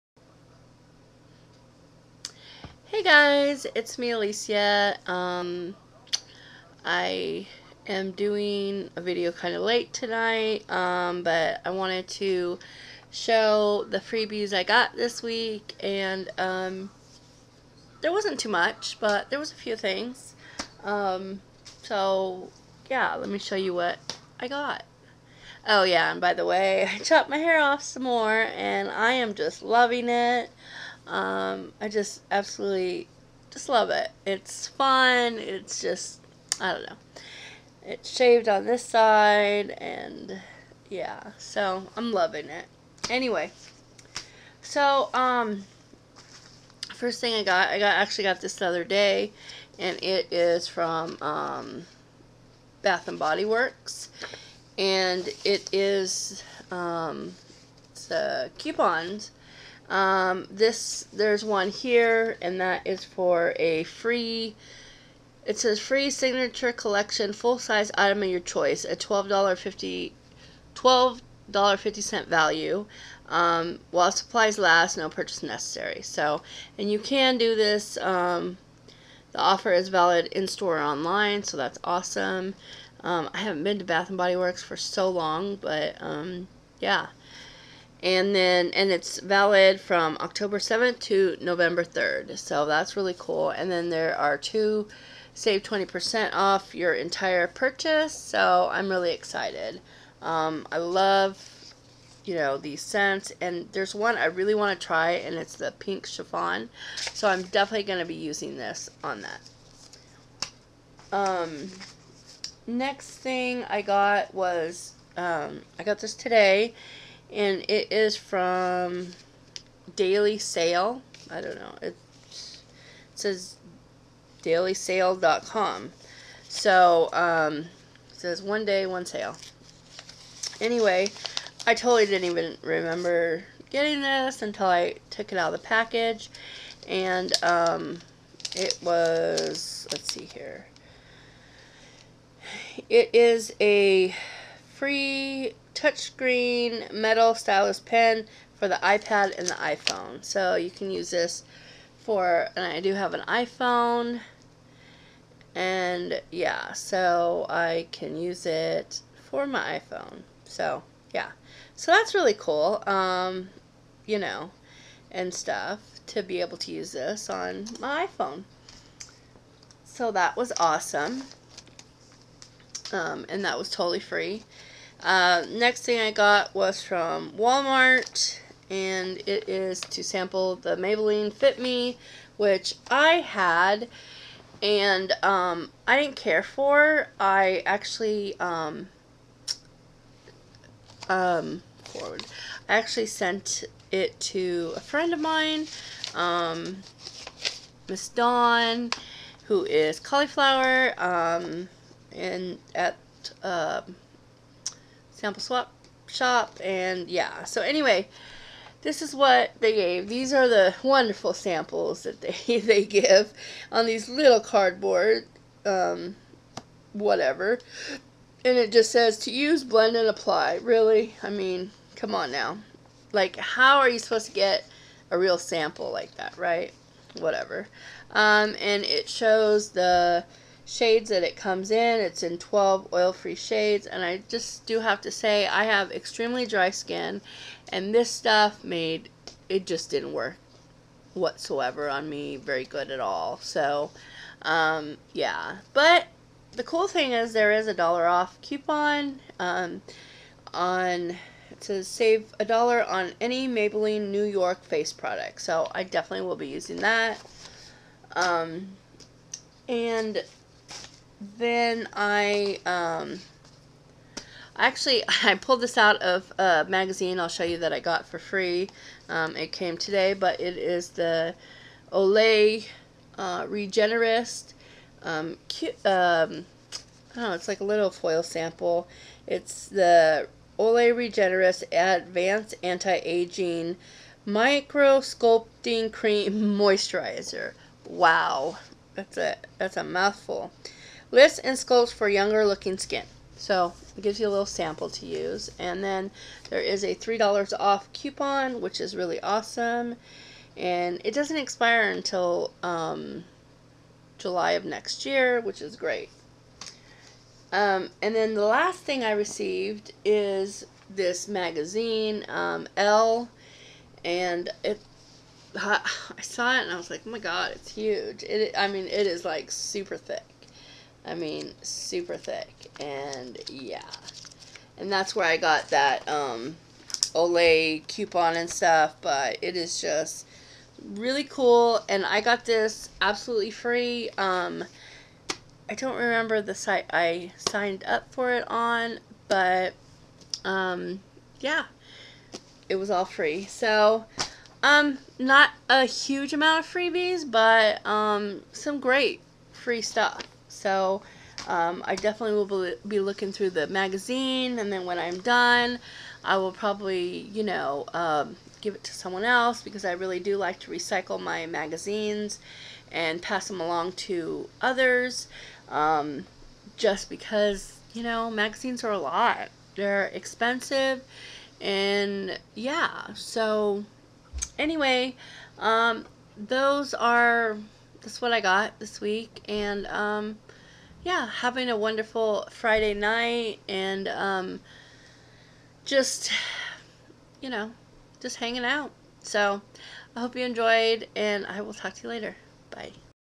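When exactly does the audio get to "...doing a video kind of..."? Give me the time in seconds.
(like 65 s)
8 s.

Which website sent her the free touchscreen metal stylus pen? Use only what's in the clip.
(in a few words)
dailysale.com.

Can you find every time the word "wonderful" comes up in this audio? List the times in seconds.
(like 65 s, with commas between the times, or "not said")
210 s, 381 s.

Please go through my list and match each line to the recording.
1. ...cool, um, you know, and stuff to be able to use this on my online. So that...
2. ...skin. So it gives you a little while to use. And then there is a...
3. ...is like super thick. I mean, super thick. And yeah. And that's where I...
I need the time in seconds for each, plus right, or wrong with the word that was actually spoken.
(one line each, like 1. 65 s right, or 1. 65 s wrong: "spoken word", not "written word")
1. 162 s wrong: "iPhone", not "online"
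2. 292 s wrong: "sample", not "while"
3. 319 s right.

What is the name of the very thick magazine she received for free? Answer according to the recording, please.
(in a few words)
Elle.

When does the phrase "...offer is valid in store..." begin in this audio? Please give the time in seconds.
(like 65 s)
79 s.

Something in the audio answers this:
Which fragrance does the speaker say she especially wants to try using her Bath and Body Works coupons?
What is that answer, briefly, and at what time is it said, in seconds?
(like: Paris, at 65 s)
Pink Chiffon, at 105 s.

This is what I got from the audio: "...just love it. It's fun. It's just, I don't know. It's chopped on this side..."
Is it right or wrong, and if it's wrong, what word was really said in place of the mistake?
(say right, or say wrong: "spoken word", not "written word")
wrong: "shaved", not "chopped".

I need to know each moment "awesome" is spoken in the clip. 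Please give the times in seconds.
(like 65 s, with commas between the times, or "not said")
81 s, 170 s, 299 s.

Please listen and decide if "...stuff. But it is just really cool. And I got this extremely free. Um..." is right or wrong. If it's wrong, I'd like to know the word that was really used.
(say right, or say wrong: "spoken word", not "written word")
wrong: "absolutely", not "extremely".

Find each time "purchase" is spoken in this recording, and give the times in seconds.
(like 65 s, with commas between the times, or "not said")
75 s, 97 s.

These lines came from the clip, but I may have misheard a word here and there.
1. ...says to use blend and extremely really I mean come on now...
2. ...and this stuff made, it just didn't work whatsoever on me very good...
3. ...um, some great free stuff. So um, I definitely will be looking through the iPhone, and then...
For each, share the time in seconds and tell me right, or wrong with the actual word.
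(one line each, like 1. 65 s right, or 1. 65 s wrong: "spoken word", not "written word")
1. 218 s wrong: "apply", not "extremely"
2. 237 s right
3. 347 s wrong: "magazine", not "iPhone".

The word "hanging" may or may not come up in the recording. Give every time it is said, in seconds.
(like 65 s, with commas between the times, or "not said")
388 s.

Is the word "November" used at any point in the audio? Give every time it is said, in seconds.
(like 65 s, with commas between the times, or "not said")
91 s.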